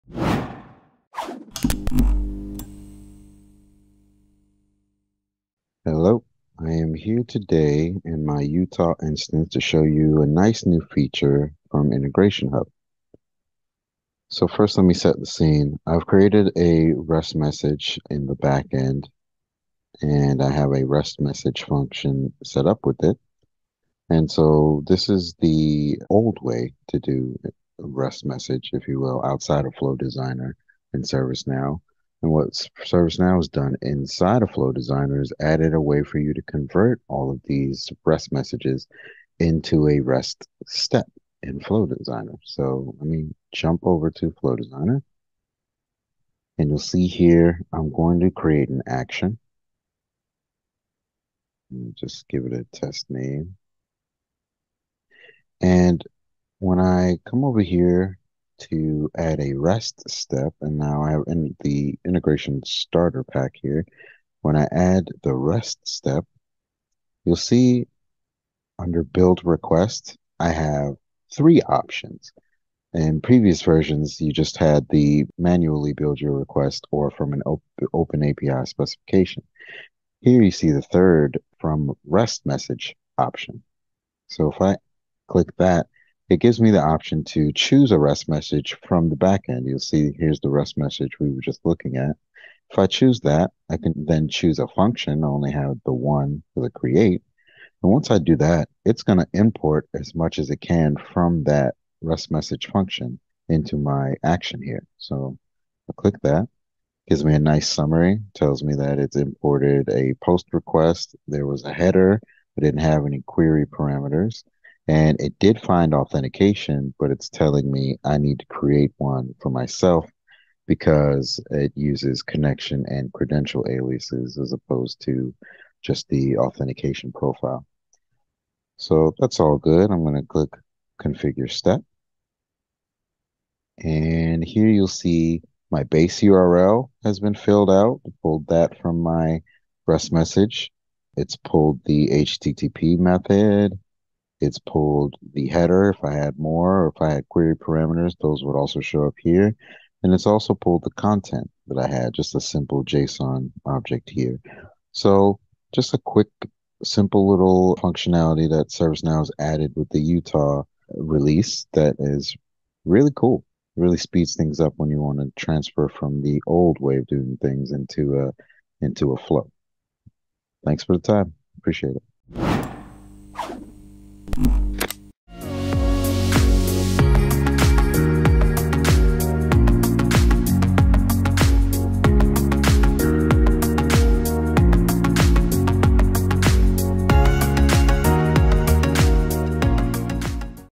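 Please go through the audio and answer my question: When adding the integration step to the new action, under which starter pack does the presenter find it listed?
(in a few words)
Integration starter pack.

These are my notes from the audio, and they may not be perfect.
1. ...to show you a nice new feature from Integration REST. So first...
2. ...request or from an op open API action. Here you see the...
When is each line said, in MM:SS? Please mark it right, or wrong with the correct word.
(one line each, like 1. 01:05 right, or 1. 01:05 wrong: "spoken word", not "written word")
1. 00:09 wrong: "Hub", not "REST"
2. 01:16 wrong: "specification", not "action".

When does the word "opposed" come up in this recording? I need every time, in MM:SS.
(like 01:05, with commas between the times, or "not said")
02:04.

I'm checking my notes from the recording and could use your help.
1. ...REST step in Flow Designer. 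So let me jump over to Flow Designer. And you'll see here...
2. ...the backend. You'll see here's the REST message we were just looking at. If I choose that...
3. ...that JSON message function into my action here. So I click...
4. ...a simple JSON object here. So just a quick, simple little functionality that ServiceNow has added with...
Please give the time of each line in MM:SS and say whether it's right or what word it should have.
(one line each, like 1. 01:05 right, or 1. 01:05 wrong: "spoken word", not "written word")
1. 00:40 right
2. 01:29 right
3. 01:41 wrong: "REST", not "JSON"
4. 02:32 right.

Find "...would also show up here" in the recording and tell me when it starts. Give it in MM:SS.
02:28.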